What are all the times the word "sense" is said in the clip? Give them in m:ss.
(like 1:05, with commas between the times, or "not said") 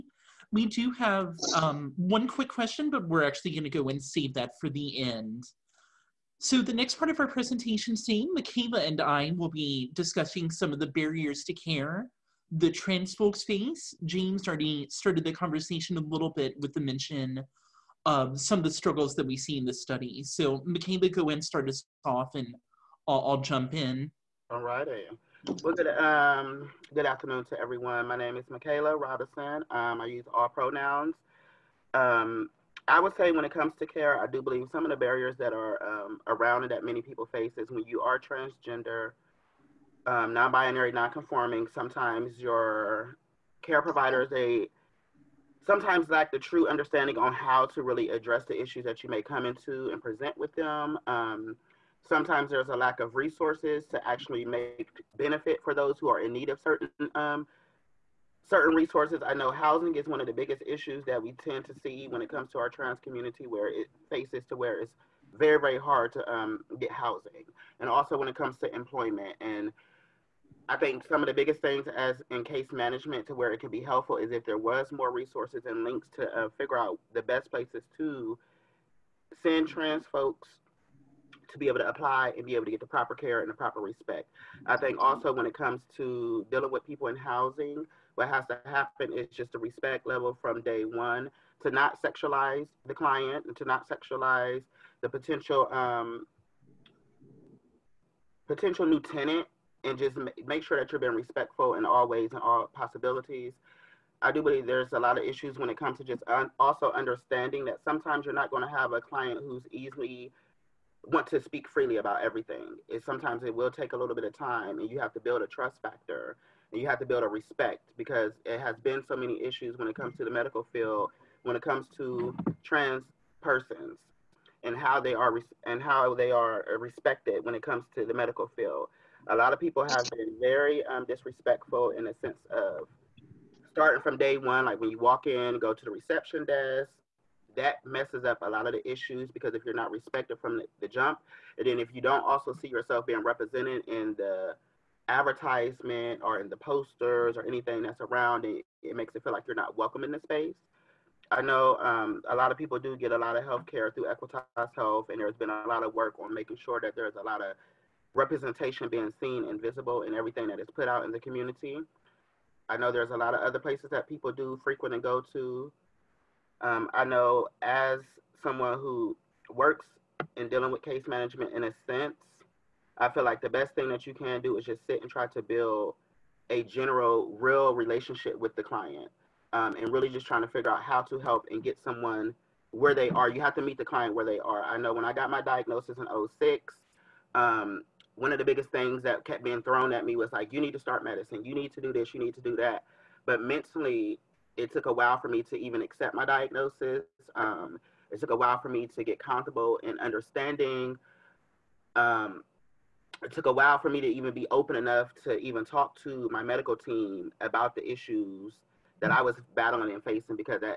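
2:12, 2:51.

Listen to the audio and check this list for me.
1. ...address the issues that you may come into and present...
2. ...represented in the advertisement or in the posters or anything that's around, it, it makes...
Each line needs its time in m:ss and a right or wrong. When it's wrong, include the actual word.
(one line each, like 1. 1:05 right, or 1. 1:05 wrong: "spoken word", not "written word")
1. 0:48 right
2. 2:23 right.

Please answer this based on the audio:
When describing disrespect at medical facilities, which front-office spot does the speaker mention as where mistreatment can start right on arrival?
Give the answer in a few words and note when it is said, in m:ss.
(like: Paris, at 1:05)
reception desk, at 2:15.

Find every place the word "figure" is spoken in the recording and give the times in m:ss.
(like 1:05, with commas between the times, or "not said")
1:16, 3:00.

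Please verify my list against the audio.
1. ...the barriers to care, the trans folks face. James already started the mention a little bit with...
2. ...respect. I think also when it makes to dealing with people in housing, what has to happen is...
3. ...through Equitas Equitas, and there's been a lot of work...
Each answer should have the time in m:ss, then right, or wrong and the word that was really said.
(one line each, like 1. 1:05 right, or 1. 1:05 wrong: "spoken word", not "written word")
1. 0:10 wrong: "conversation", not "mention"
2. 1:23 wrong: "comes", not "makes"
3. 2:33 wrong: "Health", not "Equitas".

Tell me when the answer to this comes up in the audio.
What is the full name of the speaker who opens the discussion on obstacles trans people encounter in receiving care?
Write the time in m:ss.
0:28.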